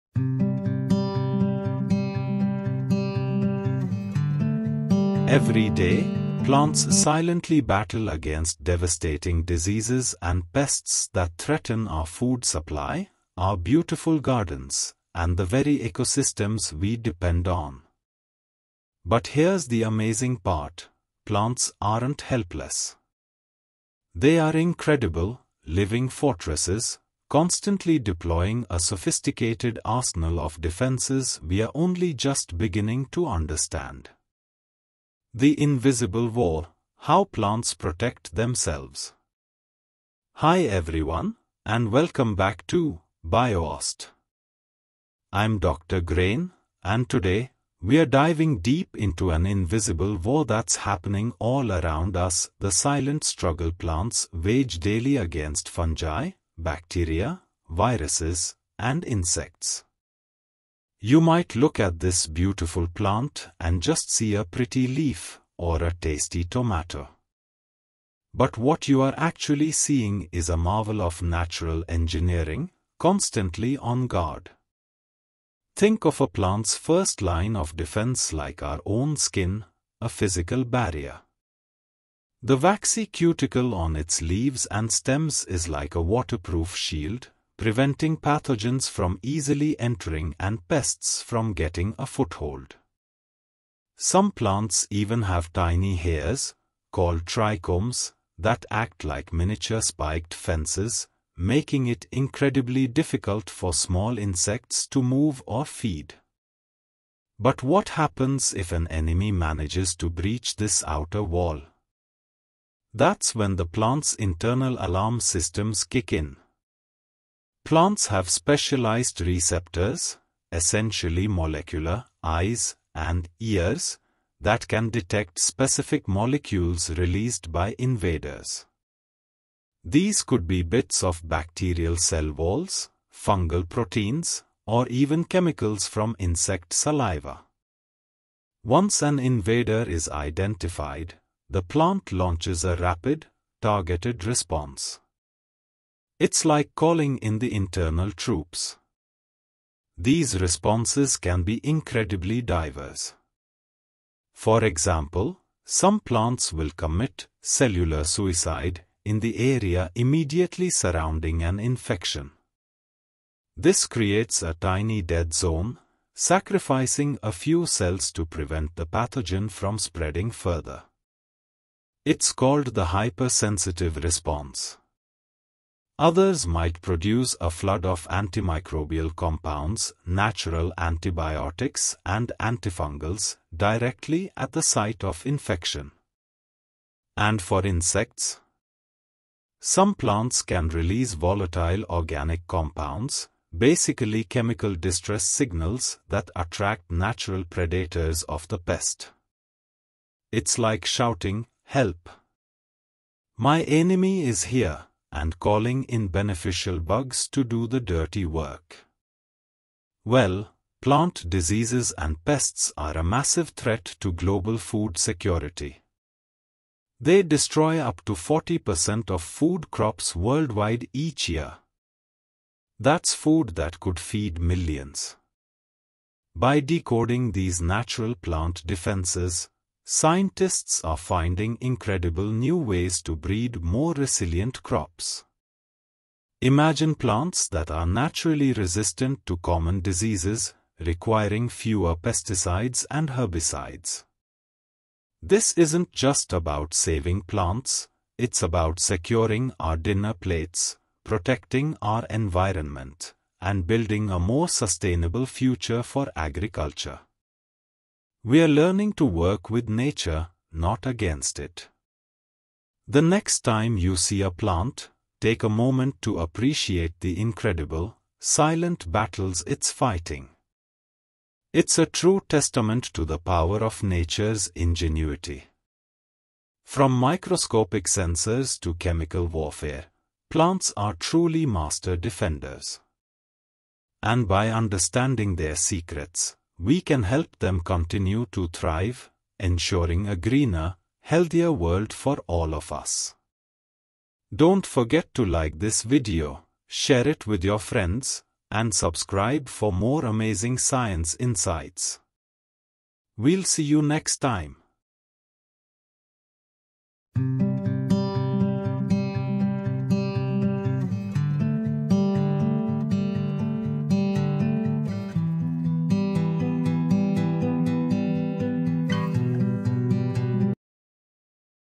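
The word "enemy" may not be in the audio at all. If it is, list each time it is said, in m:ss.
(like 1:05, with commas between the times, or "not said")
1:48, 3:23.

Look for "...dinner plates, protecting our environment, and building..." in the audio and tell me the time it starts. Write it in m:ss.
4:09.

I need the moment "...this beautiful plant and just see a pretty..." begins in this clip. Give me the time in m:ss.
1:01.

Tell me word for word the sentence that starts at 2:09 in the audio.
These could be bits of bacterial cell walls, fungal proteins, or even chemicals from insect saliva.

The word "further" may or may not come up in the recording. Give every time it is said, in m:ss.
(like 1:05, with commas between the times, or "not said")
2:50.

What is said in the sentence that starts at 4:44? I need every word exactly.
And by understanding their secrets, we can help them continue to thrive, ensuring a greener, healthier world for all of us.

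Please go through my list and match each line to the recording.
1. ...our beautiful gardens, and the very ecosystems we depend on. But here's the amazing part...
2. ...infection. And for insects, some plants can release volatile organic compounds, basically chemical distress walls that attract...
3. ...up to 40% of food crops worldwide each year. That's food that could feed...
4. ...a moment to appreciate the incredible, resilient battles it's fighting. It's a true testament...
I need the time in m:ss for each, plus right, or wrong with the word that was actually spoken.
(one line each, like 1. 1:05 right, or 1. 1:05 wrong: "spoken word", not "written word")
1. 0:13 right
2. 3:05 wrong: "signals", not "walls"
3. 3:37 right
4. 4:25 wrong: "silent", not "resilient".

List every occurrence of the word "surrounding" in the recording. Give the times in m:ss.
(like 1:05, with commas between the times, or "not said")
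2:40.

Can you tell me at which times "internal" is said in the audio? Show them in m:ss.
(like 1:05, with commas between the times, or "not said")
1:54, 2:27.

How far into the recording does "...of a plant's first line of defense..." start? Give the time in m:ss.
1:16.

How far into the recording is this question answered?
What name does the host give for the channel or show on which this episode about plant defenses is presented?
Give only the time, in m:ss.
0:43.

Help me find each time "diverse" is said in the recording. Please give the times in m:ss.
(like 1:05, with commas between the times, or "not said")
2:32.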